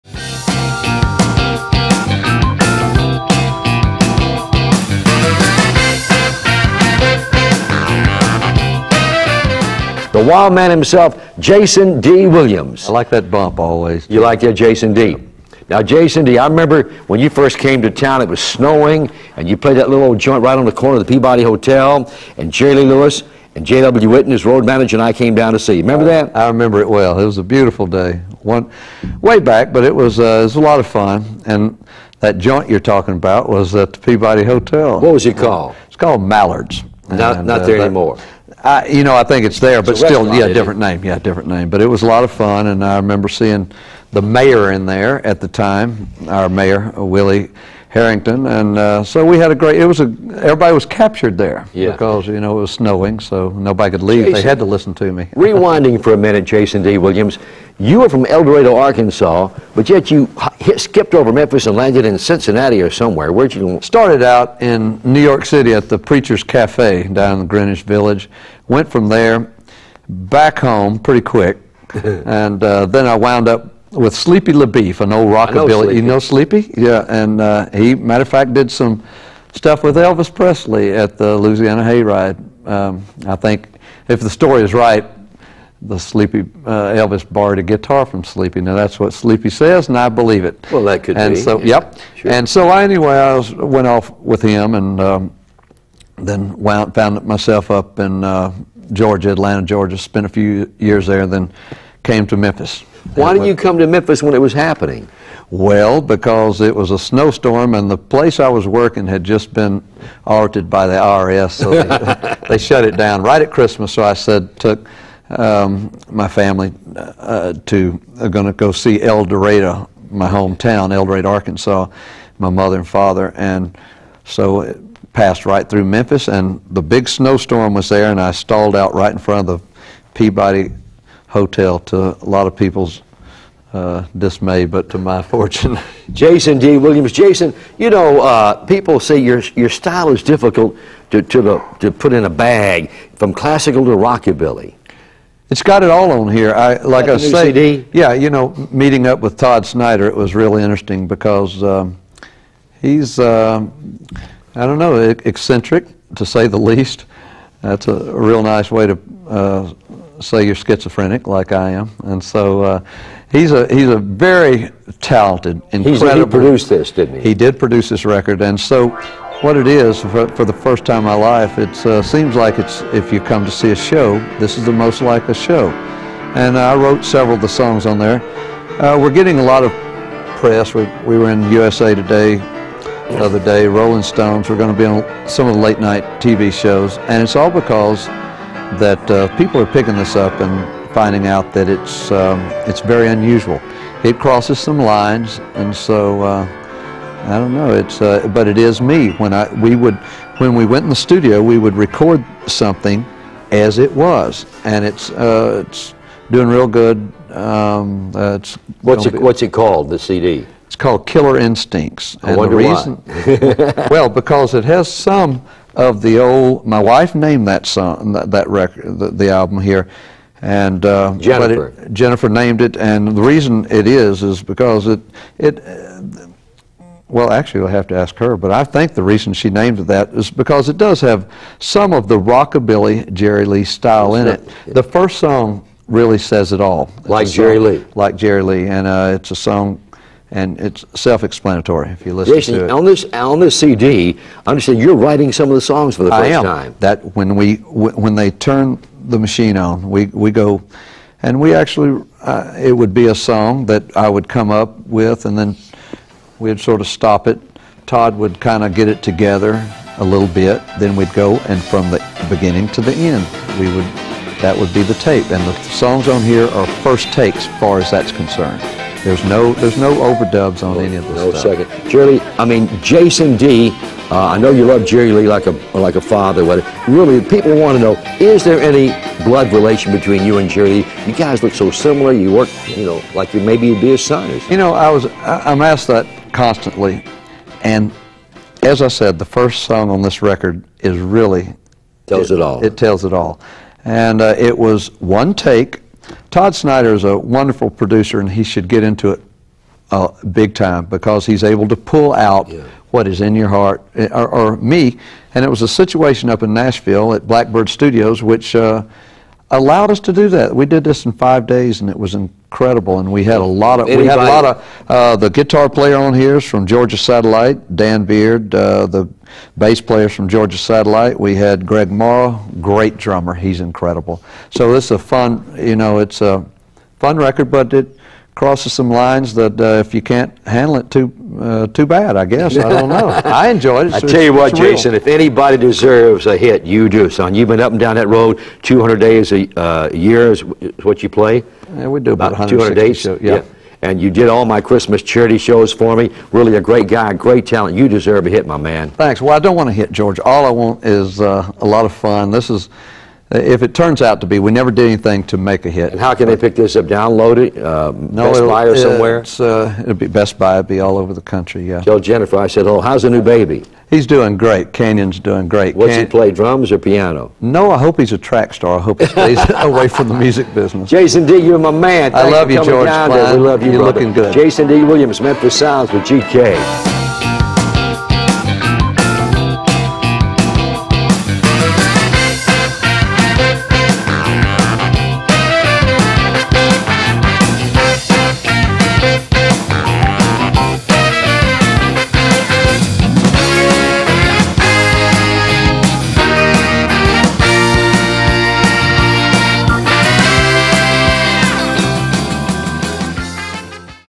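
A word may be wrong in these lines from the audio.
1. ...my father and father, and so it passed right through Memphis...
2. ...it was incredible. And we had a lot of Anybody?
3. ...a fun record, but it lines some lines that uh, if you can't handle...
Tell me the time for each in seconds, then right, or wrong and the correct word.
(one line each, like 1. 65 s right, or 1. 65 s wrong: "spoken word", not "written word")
1. 122 s wrong: "mother", not "father"
2. 311 s right
3. 326 s wrong: "crosses", not "lines".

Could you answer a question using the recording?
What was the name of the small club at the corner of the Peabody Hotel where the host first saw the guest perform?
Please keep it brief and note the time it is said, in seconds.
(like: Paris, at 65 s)
Mallard's, at 36 s.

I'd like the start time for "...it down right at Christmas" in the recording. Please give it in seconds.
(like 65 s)
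112 s.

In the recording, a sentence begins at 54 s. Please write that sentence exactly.
Jason, they had to listen to me.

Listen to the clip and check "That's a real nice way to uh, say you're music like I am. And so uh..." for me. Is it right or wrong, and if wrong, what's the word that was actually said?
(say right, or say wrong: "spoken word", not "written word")
wrong: "schizophrenic", not "music".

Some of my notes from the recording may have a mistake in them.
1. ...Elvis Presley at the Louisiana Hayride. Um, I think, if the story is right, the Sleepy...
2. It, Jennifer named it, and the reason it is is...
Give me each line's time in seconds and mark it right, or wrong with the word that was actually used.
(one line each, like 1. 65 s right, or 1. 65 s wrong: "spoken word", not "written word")
1. 79 s right
2. 221 s right.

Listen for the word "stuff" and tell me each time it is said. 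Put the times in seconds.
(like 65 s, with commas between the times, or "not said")
79 s, 271 s.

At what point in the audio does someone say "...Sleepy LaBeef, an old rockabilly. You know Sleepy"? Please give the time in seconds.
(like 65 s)
74 s.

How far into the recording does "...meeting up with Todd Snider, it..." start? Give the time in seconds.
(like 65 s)
148 s.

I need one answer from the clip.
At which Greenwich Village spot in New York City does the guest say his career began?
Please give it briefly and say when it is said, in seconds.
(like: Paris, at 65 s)
Preacher's Cafe, at 65 s.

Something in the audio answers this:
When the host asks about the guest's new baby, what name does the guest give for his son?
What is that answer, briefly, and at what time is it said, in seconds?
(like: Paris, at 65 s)
Canyon, at 364 s.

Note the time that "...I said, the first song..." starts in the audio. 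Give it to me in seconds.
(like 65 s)
288 s.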